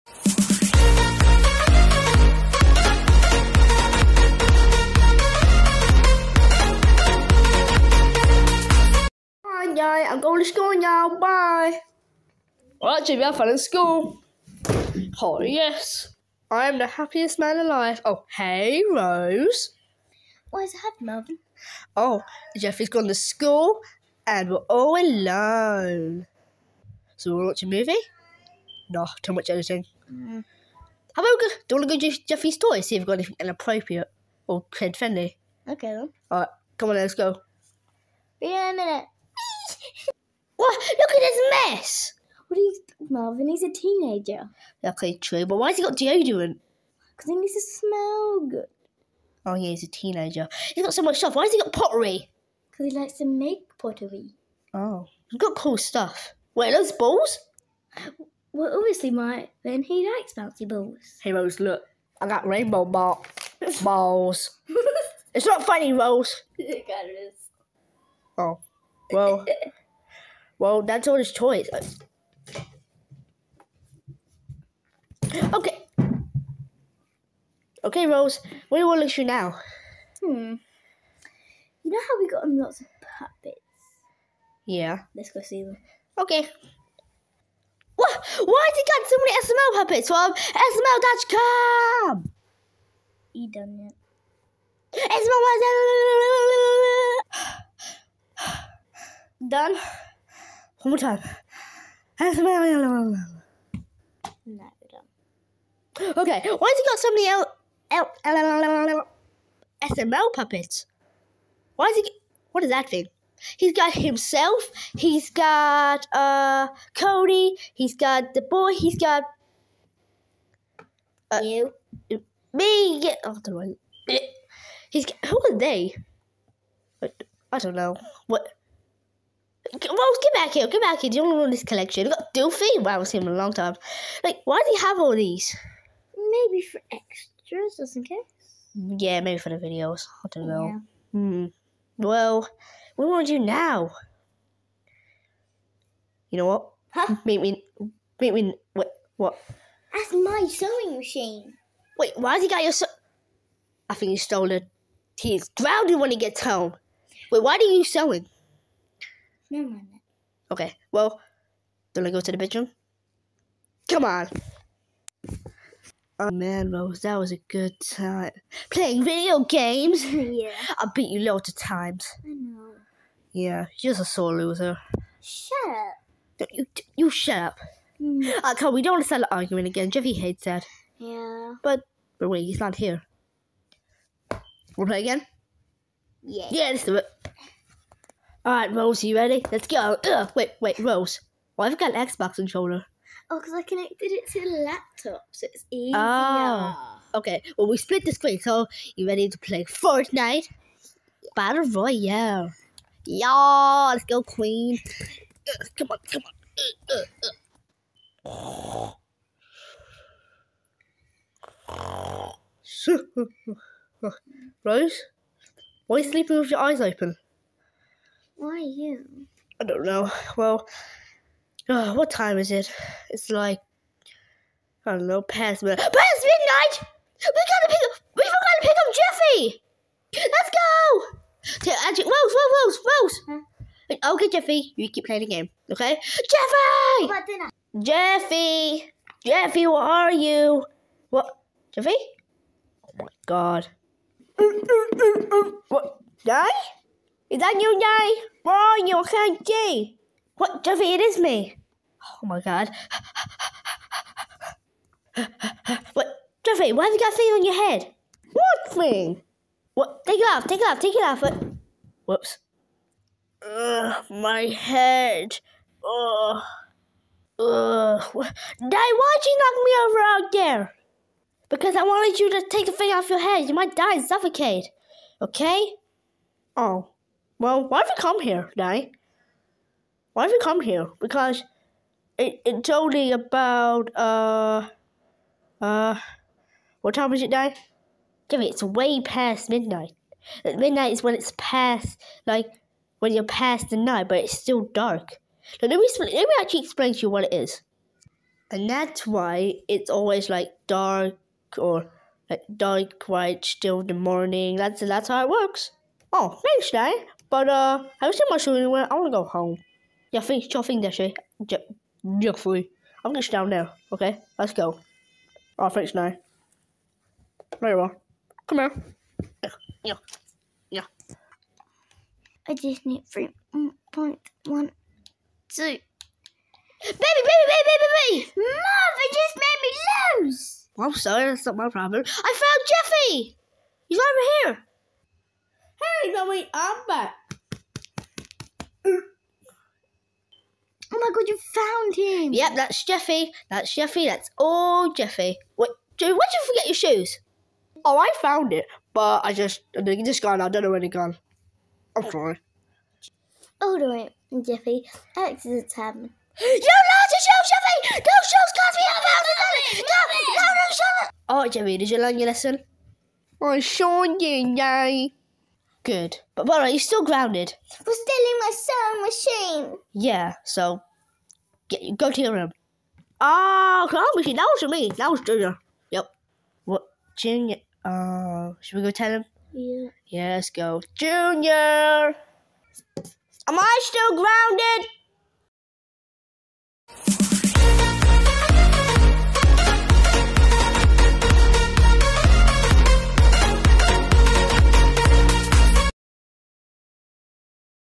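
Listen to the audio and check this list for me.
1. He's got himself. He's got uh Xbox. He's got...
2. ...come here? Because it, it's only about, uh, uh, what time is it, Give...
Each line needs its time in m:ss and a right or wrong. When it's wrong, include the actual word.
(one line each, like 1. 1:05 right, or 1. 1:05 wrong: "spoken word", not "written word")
1. 1:53 wrong: "Cody", not "Xbox"
2. 4:40 right.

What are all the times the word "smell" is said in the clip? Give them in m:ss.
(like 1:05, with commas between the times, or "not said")
0:47.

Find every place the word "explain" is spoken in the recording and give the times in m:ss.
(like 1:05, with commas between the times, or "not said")
4:56.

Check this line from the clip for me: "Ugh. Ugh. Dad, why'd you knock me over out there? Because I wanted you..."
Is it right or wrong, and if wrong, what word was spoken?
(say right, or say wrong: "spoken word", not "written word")
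right.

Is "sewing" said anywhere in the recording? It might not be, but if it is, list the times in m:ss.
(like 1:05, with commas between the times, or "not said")
2:30, 2:37, 6:08, 6:13.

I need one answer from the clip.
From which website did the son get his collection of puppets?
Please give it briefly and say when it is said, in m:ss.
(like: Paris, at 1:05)
SML.com, at 1:30.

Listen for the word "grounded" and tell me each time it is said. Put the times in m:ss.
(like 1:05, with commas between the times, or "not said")
2:35, 6:07, 6:24.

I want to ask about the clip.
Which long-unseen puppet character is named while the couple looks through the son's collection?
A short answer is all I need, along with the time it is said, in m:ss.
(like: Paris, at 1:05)
Doofy, at 2:12.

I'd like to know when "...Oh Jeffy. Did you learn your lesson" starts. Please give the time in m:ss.
6:01.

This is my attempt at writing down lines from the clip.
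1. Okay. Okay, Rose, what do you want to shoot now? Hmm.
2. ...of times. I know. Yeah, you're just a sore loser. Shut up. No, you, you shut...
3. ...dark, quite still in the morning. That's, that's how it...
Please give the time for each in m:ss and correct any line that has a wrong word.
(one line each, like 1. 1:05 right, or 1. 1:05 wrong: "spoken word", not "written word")
1. 1:15 right
2. 2:51 right
3. 5:02 right.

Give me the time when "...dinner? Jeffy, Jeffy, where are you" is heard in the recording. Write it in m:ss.
3:57.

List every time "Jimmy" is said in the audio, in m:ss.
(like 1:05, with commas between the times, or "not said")
0:13.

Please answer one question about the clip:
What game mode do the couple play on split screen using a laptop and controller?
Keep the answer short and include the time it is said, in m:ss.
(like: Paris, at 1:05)
Fortnite Battle Royale, at 3:19.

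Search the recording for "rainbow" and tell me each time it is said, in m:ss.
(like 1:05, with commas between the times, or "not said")
1:02.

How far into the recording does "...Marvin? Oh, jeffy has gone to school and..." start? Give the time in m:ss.
0:21.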